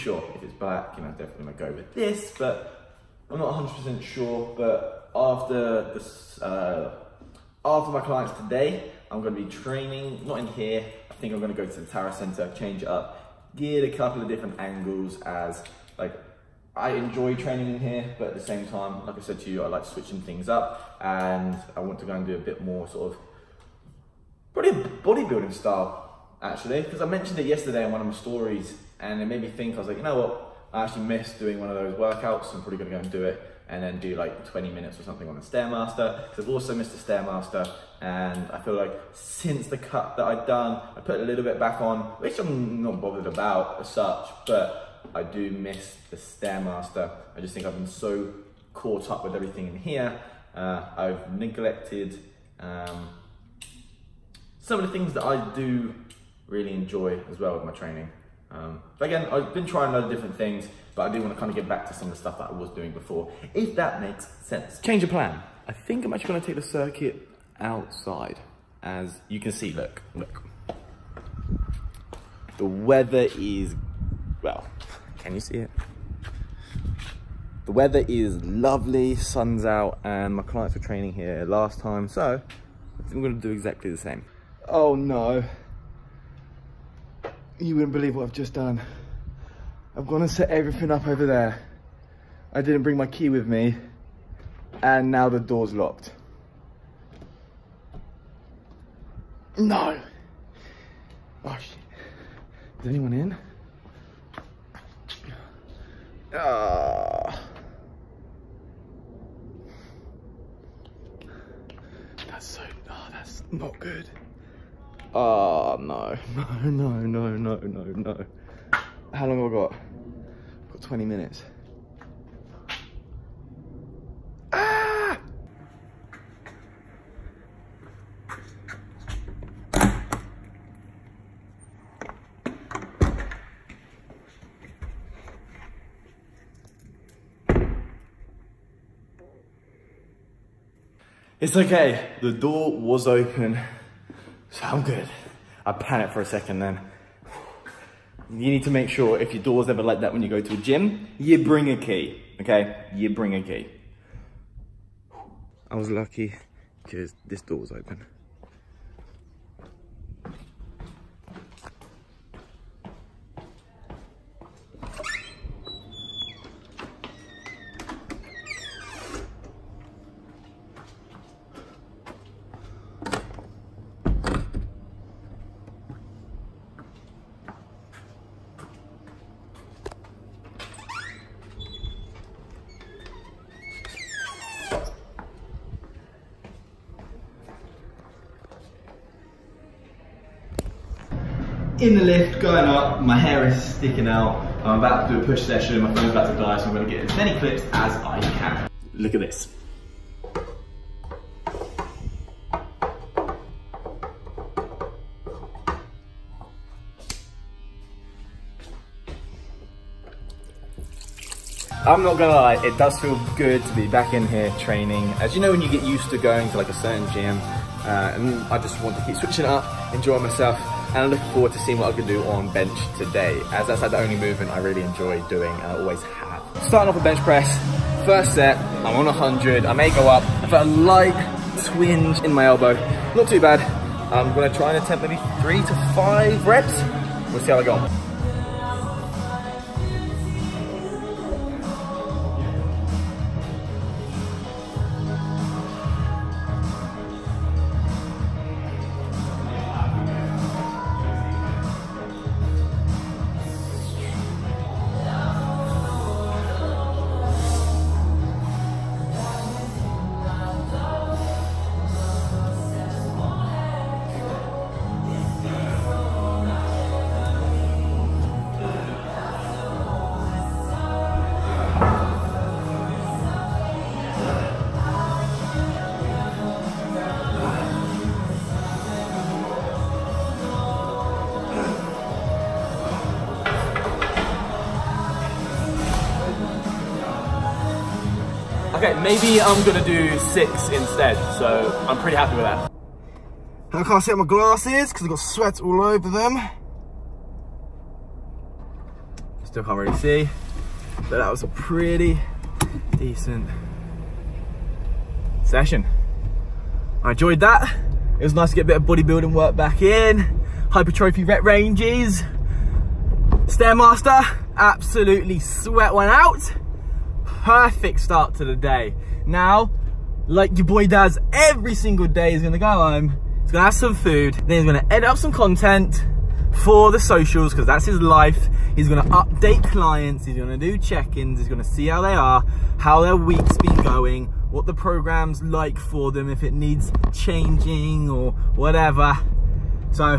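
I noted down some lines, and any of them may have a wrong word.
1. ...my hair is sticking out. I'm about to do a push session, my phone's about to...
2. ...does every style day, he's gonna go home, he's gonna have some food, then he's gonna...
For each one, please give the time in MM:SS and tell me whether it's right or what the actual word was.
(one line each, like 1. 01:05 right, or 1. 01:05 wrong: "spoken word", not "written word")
1. 03:13 right
2. 05:20 wrong: "single", not "style".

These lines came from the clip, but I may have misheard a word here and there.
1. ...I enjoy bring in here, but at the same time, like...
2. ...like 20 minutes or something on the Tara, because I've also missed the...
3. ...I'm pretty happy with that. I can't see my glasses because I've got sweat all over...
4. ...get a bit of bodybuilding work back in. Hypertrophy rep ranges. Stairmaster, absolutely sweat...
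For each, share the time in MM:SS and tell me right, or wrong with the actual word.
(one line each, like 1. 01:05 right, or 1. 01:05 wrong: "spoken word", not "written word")
1. 00:16 wrong: "training", not "bring"
2. 00:34 wrong: "Stairmaster", not "Tara"
3. 04:51 right
4. 05:08 right.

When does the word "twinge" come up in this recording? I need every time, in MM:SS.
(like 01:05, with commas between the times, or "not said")
03:51.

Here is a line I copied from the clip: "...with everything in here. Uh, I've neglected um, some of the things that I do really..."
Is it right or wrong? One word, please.
right.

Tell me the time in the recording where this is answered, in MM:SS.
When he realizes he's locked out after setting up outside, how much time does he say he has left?
01:59.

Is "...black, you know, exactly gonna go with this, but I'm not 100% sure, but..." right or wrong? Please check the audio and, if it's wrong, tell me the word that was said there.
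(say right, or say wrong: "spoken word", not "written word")
wrong: "definitely", not "exactly".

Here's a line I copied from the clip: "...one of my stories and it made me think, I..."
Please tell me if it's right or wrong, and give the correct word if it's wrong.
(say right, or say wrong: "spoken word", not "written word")
right.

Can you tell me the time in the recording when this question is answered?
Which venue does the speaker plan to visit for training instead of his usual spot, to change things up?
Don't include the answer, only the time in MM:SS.
00:11.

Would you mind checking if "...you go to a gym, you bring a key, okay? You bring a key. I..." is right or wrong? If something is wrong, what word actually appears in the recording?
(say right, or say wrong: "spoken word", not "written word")
right.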